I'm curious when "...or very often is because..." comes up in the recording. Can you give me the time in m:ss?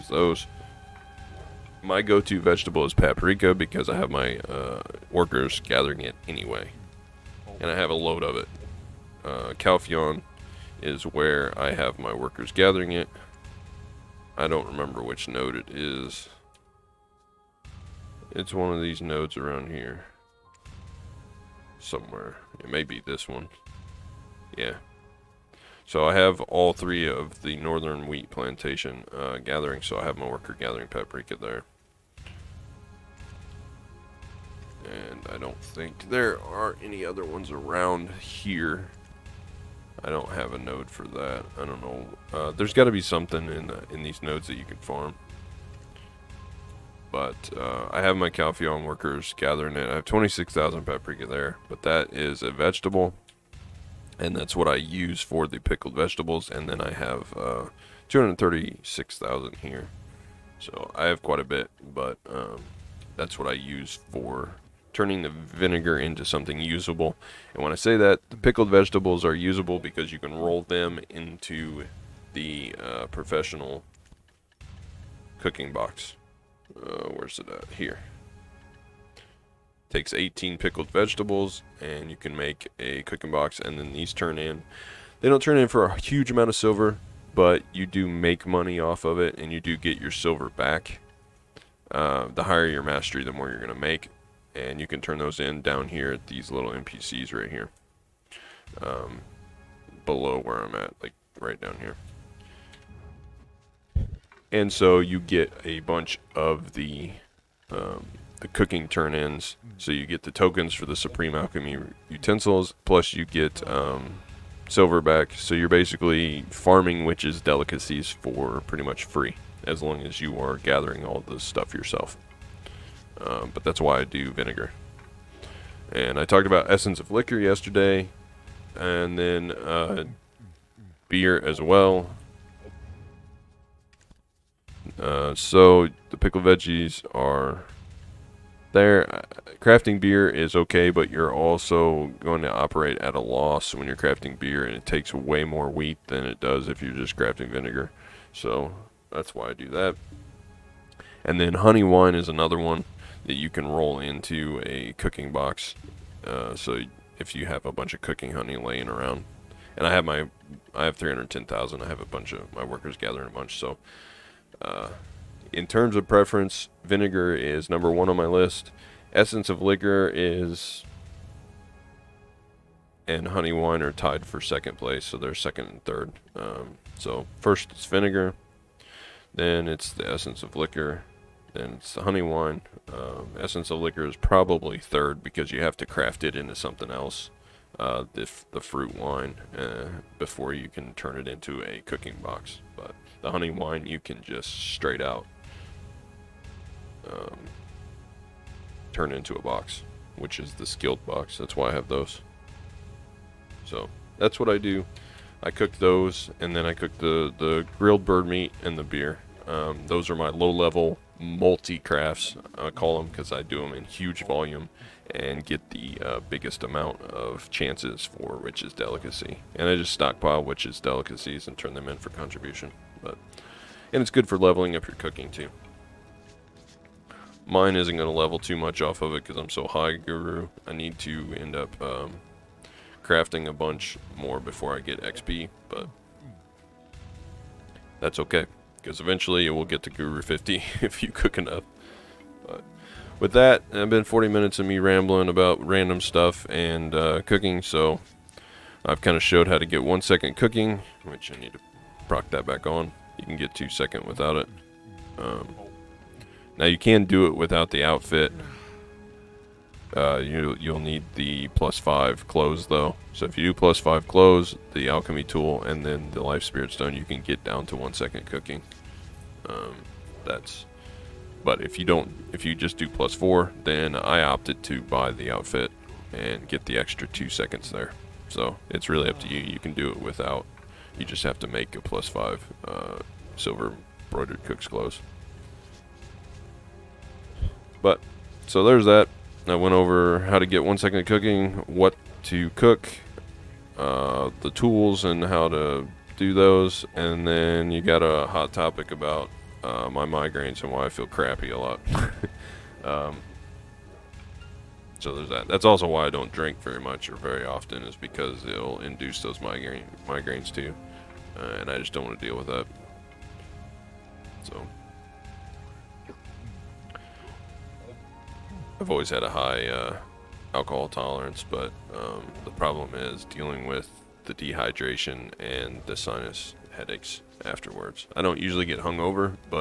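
5:07.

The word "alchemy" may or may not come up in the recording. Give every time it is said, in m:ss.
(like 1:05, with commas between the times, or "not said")
1:51, 4:24.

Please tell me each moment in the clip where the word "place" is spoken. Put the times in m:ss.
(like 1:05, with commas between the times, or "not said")
2:54.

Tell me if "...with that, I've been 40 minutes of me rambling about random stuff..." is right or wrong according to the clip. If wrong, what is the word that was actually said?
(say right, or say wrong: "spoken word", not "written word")
right.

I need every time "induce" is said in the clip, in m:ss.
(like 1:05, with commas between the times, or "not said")
5:08.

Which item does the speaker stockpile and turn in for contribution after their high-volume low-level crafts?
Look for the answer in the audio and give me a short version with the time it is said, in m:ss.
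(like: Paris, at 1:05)
Witch's Delicacy, at 3:40.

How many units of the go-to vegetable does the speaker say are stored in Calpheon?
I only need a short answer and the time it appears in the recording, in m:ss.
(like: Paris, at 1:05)
26,000, at 0:50.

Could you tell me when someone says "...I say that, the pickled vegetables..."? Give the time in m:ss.
1:07.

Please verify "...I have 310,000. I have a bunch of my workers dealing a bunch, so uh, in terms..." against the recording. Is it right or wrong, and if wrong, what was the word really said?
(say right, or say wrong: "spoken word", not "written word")
wrong: "gathering", not "dealing".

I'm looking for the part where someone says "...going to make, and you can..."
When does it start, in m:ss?
1:33.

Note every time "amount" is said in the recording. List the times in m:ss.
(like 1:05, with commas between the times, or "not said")
1:26, 3:36.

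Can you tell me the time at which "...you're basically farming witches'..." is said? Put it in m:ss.
1:55.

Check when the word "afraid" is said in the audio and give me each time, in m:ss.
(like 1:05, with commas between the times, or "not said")
not said.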